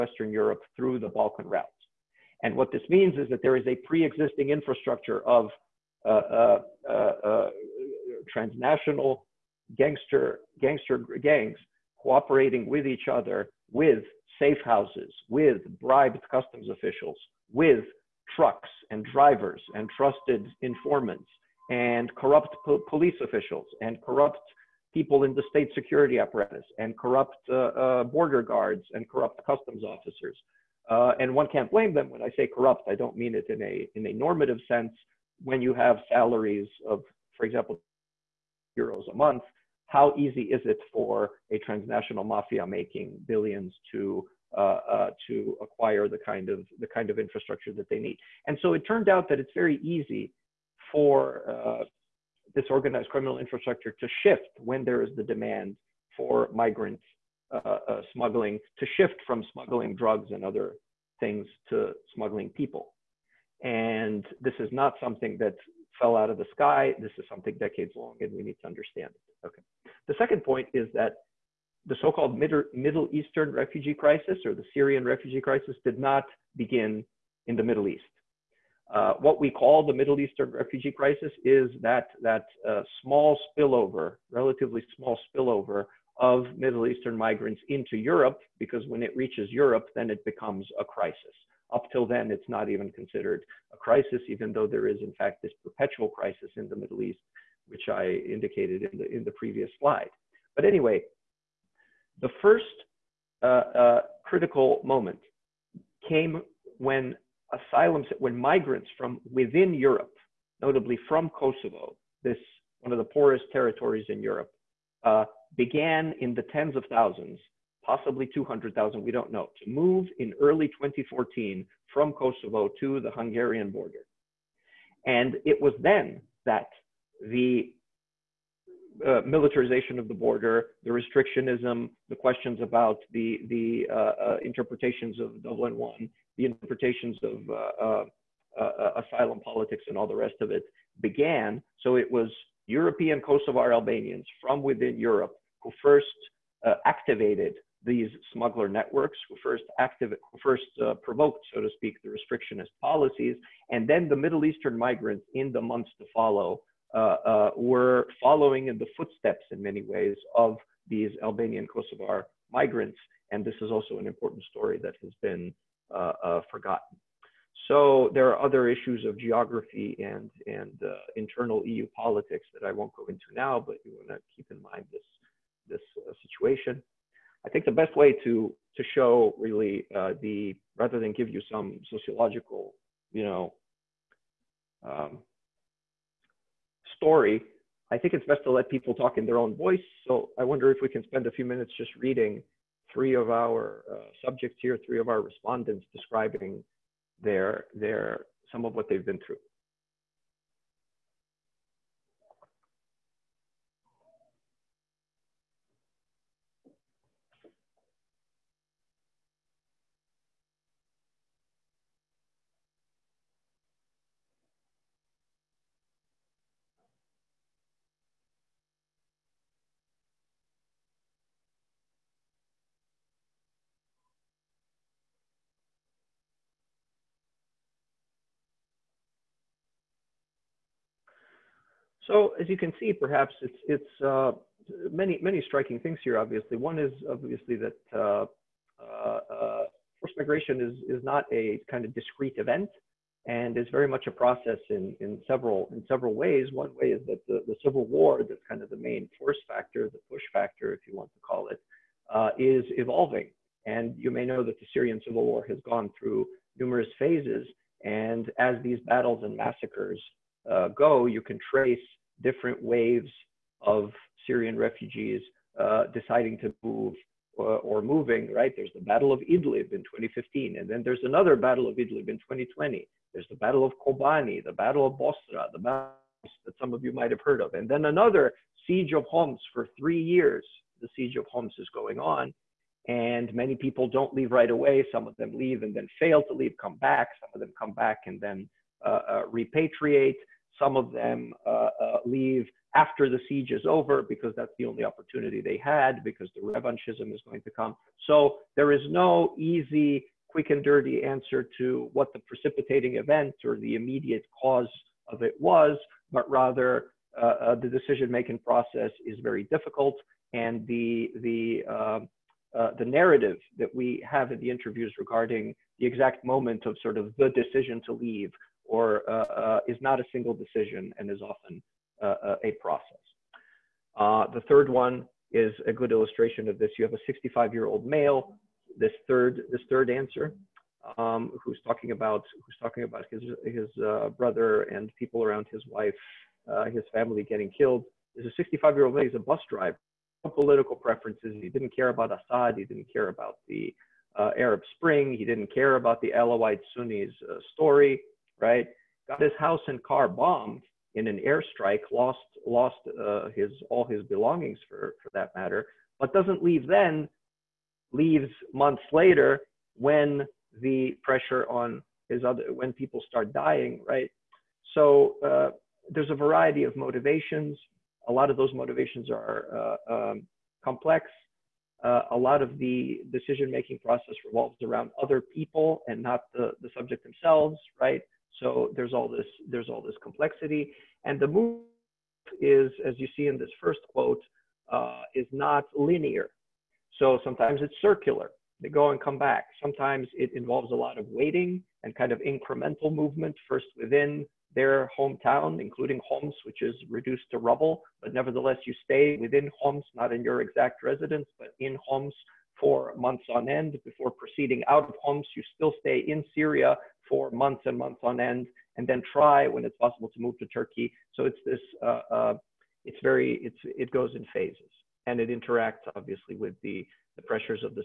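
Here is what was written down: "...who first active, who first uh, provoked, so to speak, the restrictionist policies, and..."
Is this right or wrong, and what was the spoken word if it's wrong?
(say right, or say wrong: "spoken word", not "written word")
right.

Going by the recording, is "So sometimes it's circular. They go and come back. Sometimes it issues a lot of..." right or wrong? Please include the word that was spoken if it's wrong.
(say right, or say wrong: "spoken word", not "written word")
wrong: "involves", not "issues".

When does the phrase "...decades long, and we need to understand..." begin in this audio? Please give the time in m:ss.
1:07.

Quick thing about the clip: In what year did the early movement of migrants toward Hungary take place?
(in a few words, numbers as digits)
2014.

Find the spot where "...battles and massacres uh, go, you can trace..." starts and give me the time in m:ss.
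4:18.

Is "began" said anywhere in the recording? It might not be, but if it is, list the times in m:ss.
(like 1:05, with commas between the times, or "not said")
1:55, 2:21.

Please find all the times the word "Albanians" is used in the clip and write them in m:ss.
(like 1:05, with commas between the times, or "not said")
2:23, 2:41.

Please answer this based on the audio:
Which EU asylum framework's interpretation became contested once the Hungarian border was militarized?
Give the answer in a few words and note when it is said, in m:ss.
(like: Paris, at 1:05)
Dublin One, at 2:15.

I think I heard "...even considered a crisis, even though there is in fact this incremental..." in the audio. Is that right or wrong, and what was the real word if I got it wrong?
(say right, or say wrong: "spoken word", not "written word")
wrong: "perpetual", not "incremental".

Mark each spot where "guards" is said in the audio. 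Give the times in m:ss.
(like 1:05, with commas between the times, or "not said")
0:28.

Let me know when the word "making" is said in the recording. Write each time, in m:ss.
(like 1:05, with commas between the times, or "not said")
0:42, 5:07, 6:13.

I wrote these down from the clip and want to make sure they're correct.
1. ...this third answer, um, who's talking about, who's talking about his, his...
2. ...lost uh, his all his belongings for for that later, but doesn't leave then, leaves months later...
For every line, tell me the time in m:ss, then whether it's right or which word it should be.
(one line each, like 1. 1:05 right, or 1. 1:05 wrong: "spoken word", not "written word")
1. 5:29 right
2. 5:52 wrong: "matter", not "later".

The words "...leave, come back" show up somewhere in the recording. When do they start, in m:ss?
4:46.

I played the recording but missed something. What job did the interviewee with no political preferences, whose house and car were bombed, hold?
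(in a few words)
Bus driver.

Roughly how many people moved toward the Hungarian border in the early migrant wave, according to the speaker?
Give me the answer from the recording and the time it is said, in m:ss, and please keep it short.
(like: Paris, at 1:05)
200,000, at 1:58.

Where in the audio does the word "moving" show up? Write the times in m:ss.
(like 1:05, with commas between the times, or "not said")
4:27.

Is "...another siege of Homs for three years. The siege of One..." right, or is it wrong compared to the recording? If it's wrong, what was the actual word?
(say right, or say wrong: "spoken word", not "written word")
wrong: "Homs", not "One".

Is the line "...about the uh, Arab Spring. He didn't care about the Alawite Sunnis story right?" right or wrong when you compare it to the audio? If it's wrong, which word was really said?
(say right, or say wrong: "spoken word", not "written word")
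right.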